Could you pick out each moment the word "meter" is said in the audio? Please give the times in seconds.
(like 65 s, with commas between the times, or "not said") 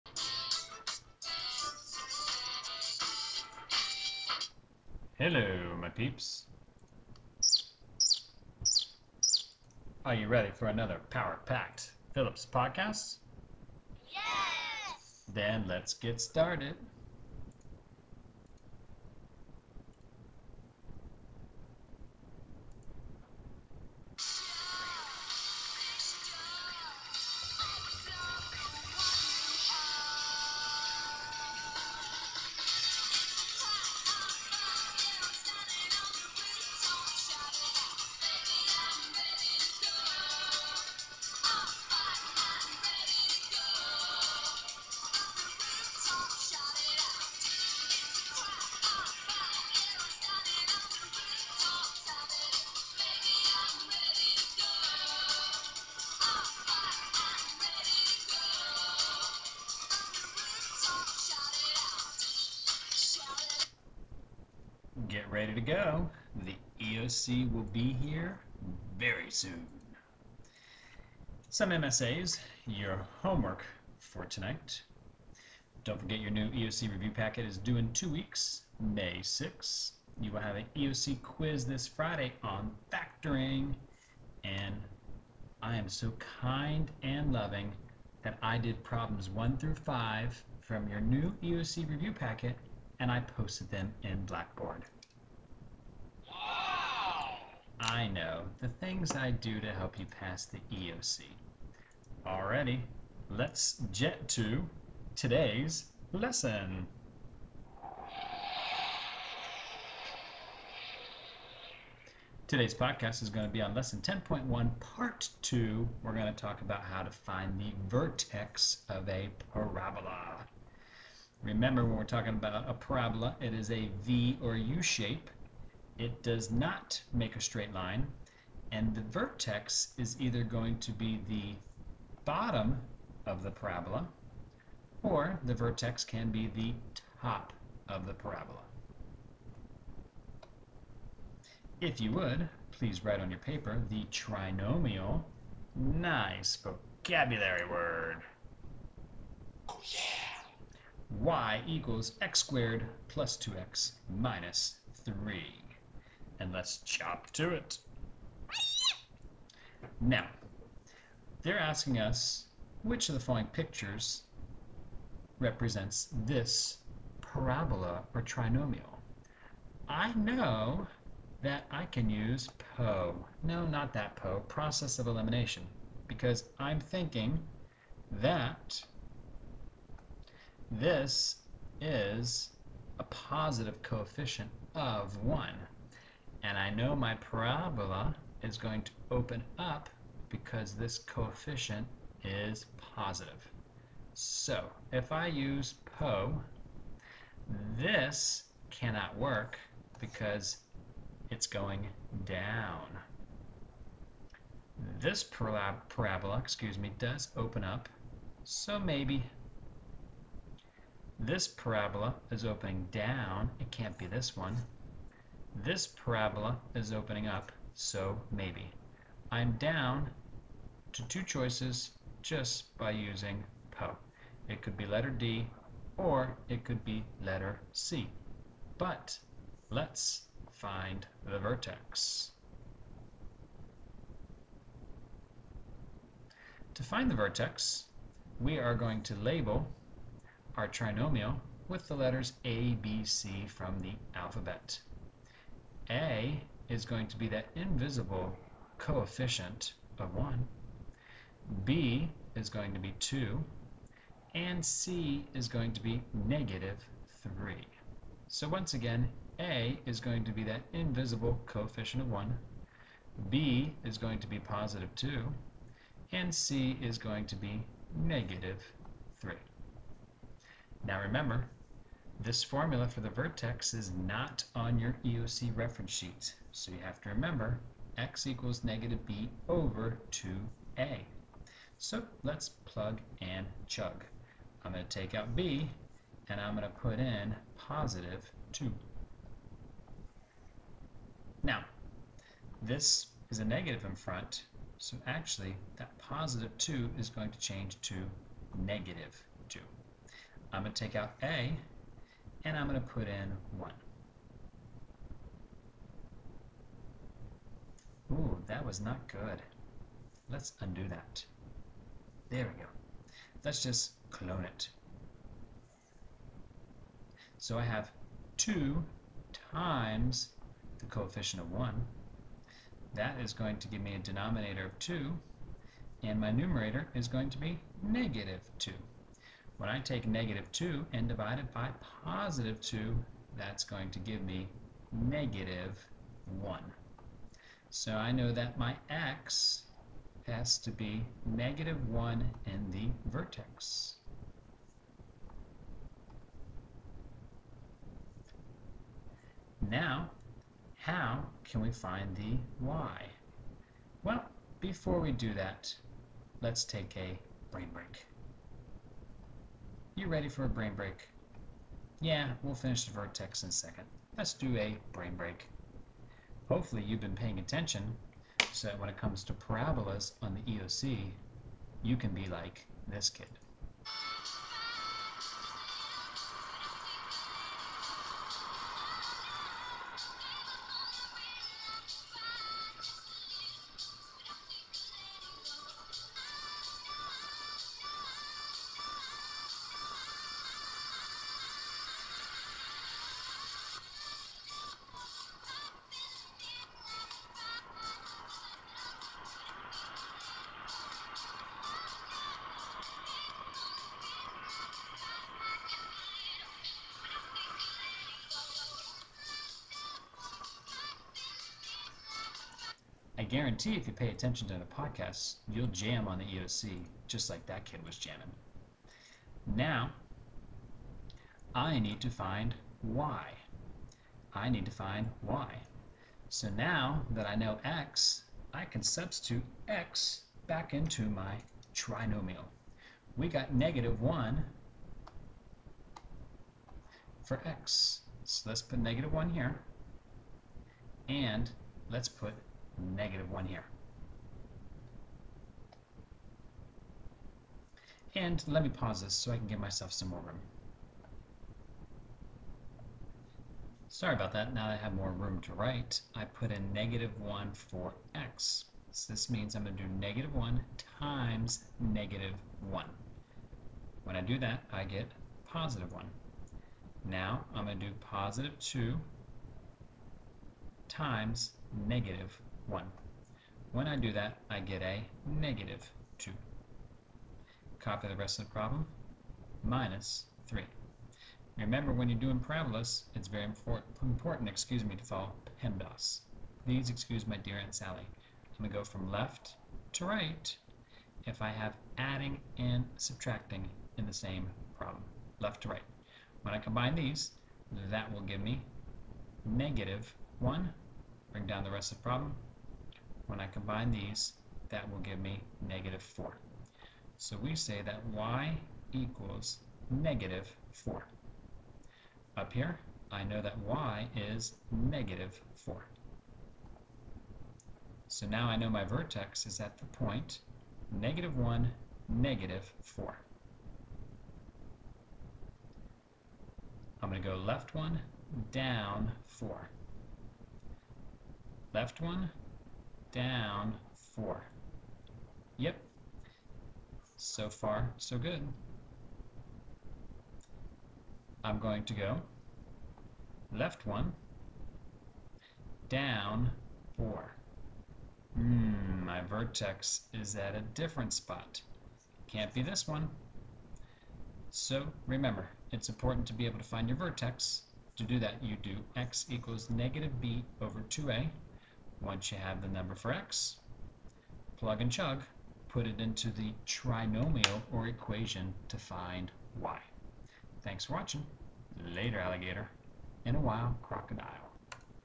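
not said.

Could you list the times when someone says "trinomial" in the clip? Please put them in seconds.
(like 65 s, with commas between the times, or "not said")
144 s, 168 s, 240 s, 431 s, 566 s.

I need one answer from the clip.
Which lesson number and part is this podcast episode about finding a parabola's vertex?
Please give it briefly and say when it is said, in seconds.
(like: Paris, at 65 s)
10.1, part 2, at 113 s.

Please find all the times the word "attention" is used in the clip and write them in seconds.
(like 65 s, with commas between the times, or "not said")
367 s, 414 s.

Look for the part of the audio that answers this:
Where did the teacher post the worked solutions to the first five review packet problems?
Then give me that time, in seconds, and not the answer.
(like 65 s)
94 s.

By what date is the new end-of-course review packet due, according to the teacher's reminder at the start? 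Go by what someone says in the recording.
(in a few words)
May 6th.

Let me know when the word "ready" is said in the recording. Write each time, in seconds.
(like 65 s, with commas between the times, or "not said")
10 s, 65 s, 360 s.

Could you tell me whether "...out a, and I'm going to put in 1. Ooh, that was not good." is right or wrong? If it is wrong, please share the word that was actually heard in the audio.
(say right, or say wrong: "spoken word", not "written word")
right.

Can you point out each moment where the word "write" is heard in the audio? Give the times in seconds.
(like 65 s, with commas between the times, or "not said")
143 s, 455 s.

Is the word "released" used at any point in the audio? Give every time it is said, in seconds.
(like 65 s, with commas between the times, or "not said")
not said.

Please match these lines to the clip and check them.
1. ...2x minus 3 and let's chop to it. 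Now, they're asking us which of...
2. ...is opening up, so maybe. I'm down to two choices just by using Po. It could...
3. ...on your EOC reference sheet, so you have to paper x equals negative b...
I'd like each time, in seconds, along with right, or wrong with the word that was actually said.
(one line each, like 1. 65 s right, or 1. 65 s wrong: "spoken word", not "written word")
1. 153 s right
2. 216 s right
3. 274 s wrong: "remember", not "paper".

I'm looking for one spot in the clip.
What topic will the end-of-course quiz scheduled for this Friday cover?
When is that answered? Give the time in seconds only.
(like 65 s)
82 s.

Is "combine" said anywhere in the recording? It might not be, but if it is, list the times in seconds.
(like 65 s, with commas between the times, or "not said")
496 s, 503 s.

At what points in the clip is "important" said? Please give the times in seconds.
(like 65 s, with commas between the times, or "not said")
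483 s, 555 s.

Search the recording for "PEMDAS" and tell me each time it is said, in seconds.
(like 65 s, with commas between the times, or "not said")
485 s.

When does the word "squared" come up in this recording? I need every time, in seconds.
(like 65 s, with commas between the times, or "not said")
152 s.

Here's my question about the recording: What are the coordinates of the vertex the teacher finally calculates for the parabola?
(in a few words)
(-1, -4).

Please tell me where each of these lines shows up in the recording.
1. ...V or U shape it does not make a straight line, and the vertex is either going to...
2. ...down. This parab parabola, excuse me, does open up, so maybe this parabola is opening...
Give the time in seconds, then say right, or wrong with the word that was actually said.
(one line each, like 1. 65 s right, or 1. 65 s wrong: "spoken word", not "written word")
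1. 124 s right
2. 202 s right.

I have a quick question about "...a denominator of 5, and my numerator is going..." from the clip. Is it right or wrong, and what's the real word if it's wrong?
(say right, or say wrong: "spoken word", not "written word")
wrong: "2", not "5".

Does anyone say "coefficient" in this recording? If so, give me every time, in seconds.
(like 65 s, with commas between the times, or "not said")
183 s, 190 s, 248 s, 261 s, 320 s.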